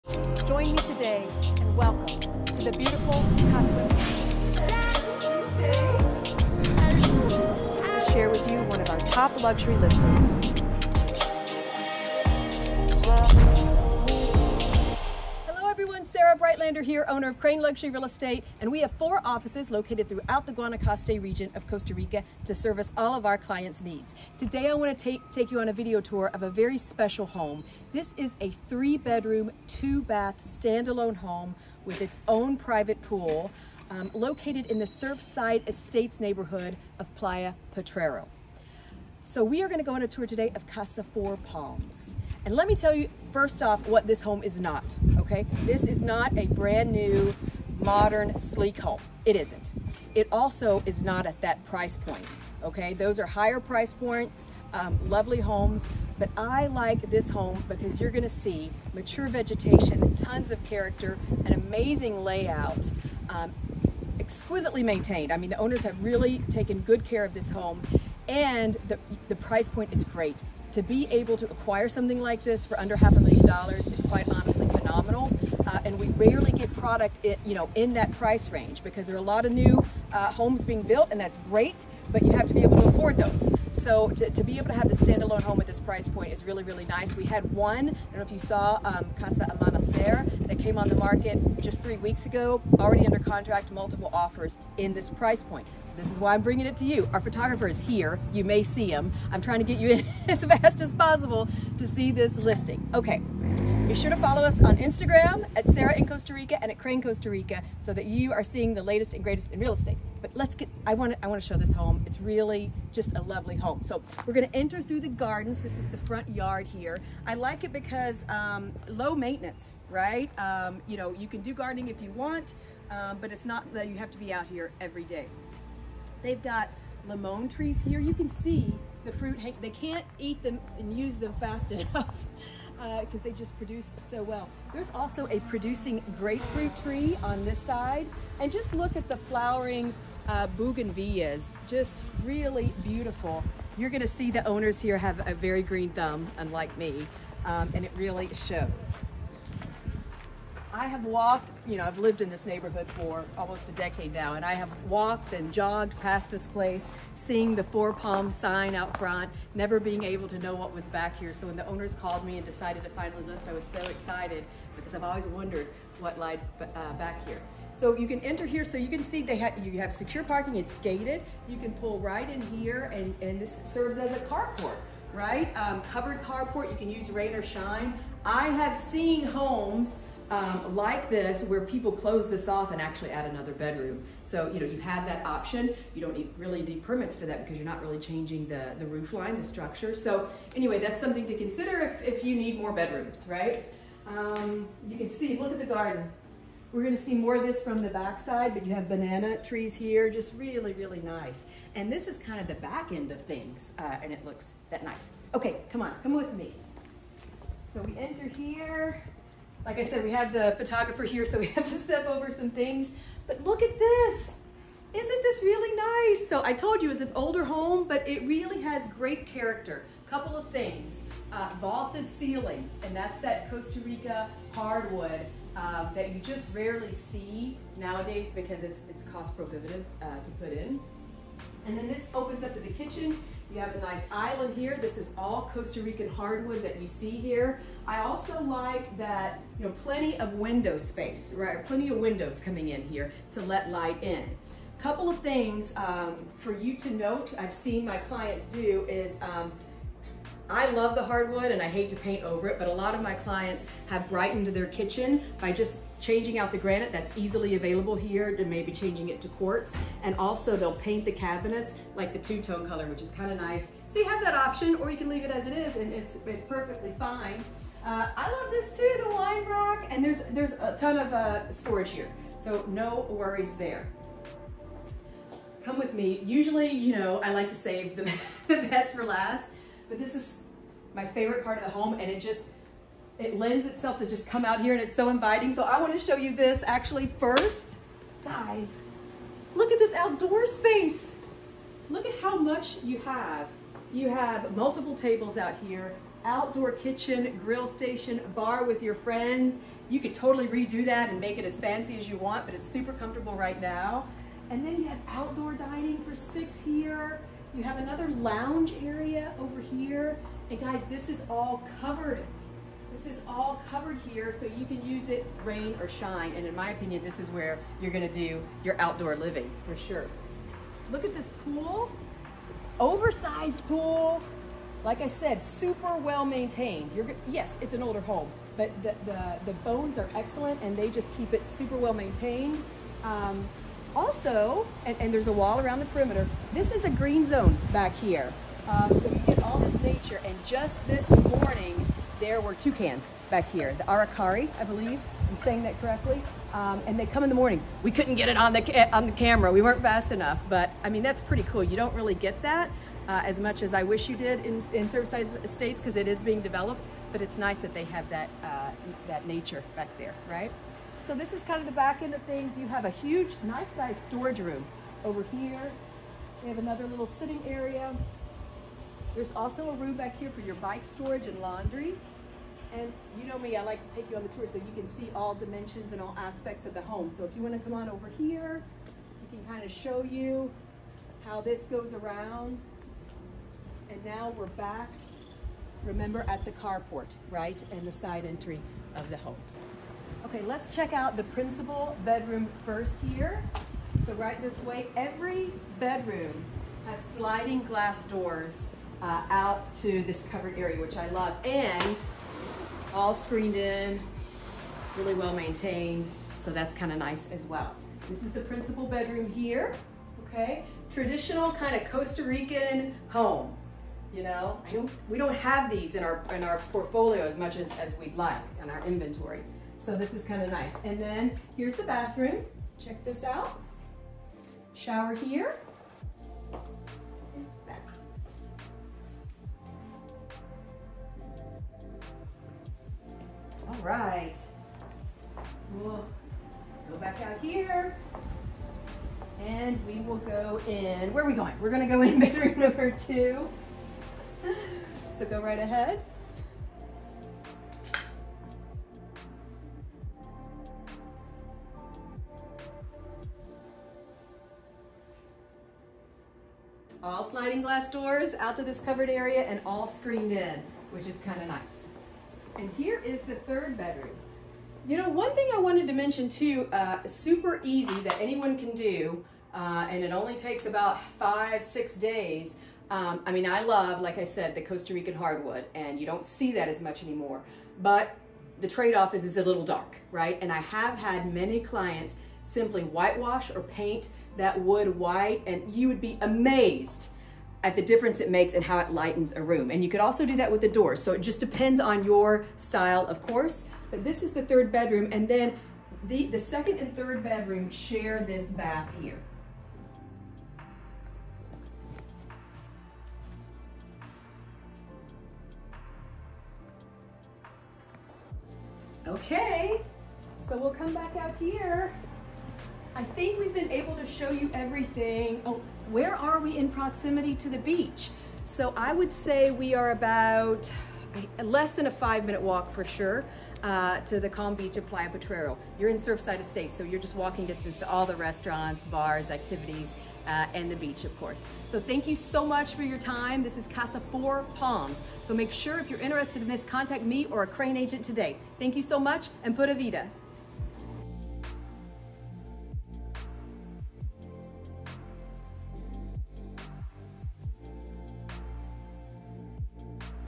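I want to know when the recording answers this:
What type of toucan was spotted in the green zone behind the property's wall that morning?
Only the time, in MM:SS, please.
05:43.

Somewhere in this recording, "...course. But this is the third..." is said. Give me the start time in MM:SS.
08:13.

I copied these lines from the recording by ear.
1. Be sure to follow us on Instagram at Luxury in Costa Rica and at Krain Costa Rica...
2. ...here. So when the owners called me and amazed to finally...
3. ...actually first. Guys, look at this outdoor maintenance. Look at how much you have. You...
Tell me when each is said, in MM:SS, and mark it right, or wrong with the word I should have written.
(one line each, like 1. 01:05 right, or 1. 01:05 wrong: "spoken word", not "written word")
1. 01:43 wrong: "Sarah", not "Luxury"
2. 02:41 wrong: "decided", not "amazed"
3. 04:46 wrong: "space", not "maintenance".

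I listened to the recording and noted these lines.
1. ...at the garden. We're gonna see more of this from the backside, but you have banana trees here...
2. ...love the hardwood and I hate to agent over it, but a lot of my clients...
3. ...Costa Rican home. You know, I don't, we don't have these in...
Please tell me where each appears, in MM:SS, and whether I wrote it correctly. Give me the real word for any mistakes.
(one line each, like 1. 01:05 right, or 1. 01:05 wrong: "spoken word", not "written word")
1. 03:15 right
2. 04:10 wrong: "paint", not "agent"
3. 06:51 right.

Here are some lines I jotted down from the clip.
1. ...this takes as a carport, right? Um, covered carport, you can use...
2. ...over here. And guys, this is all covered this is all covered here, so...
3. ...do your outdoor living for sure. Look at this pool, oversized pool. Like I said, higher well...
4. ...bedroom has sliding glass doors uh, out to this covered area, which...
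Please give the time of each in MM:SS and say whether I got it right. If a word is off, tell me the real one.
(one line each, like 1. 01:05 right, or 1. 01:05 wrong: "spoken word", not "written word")
1. 02:53 wrong: "serves", not "takes"
2. 05:09 right
3. 05:18 wrong: "super", not "higher"
4. 06:35 right.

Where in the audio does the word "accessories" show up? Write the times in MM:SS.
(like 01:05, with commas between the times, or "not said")
not said.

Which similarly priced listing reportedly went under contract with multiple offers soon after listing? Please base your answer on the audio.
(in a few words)
Casa Amanecer.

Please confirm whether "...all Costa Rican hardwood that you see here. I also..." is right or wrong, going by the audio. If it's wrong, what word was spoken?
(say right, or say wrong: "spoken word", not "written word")
right.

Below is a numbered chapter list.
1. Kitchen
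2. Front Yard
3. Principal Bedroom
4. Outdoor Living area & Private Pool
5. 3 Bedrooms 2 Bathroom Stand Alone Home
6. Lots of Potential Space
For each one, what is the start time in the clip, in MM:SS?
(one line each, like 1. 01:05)
1. 03:52
2. 01:57
3. 06:40
4. 04:49
5. 00:32
6. 03:01.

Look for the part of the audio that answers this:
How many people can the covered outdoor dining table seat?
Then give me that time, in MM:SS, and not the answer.
05:05.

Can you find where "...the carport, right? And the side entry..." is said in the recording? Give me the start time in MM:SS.
06:26.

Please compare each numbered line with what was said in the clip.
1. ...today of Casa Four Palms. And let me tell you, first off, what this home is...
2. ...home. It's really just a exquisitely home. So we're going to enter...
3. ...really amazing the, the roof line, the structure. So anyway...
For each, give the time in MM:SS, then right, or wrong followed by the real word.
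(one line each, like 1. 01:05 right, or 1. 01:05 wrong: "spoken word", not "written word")
1. 00:40 right
2. 01:51 wrong: "lovely", not "exquisitely"
3. 03:07 wrong: "changing", not "amazing".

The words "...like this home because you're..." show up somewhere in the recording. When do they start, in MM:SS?
00:56.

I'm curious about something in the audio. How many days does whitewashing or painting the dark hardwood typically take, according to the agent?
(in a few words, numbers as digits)
5 to 6 days.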